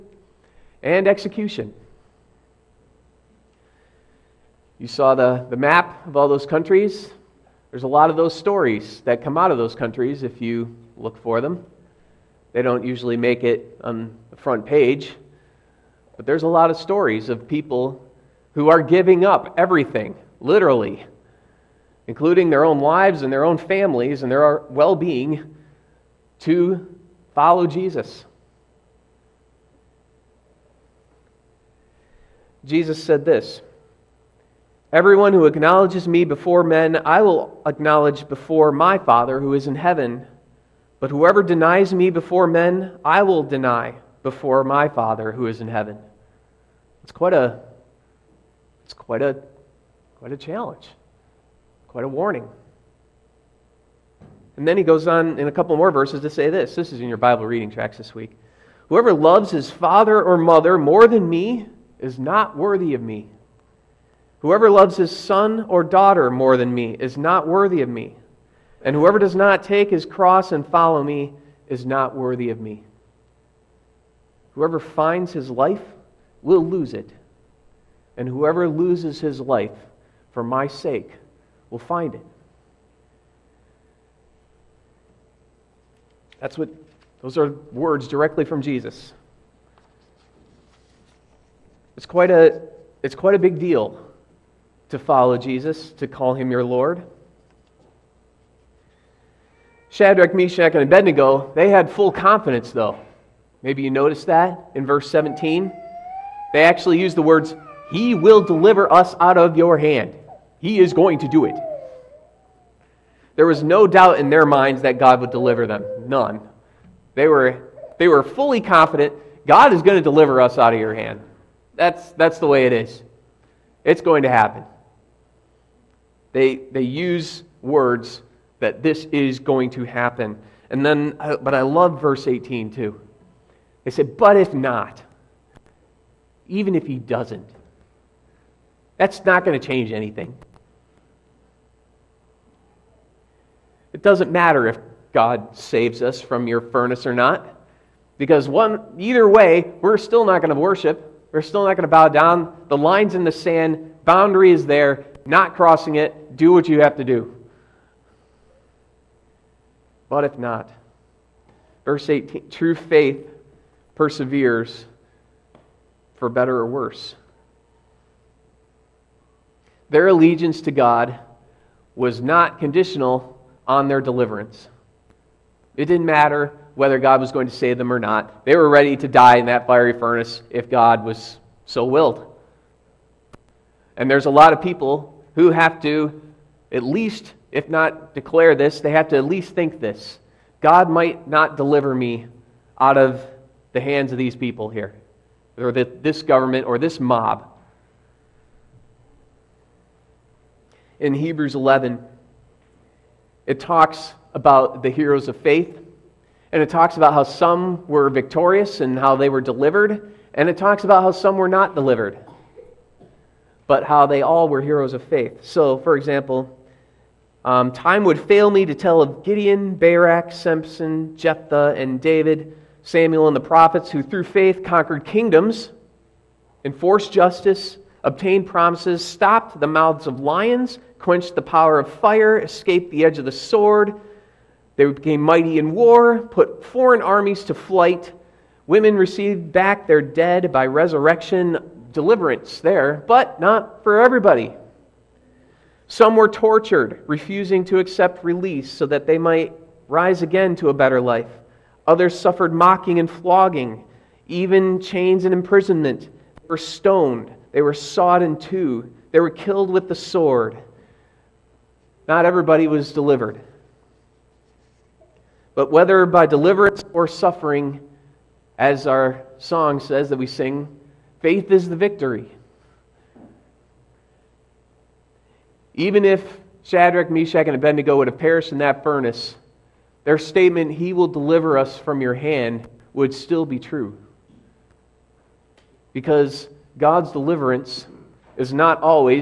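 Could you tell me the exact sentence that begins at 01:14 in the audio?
Whoever finds his life will lose it.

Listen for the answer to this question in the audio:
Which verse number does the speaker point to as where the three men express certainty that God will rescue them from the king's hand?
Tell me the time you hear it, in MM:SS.
01:44.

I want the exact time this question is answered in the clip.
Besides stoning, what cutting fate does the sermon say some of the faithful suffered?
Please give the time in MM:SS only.
04:17.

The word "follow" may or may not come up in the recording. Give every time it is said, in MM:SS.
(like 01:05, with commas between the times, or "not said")
00:27, 01:10, 01:35.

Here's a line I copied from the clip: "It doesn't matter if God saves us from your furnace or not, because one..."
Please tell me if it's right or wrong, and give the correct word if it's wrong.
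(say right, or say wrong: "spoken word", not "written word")
right.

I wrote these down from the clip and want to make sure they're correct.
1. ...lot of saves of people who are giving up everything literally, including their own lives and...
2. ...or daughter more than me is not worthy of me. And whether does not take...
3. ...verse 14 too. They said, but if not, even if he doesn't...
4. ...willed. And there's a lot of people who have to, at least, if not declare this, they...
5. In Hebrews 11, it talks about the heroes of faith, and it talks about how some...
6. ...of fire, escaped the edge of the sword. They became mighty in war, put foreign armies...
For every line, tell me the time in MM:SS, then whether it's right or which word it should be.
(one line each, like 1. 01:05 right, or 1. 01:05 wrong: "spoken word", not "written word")
1. 00:16 wrong: "stories", not "saves"
2. 01:05 wrong: "whoever", not "whether"
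3. 02:12 wrong: "18", not "14"
4. 03:01 right
5. 03:21 right
6. 03:51 right.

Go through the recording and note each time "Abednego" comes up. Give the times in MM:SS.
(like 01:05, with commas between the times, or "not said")
01:40, 04:37.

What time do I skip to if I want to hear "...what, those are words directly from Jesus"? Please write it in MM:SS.
01:26.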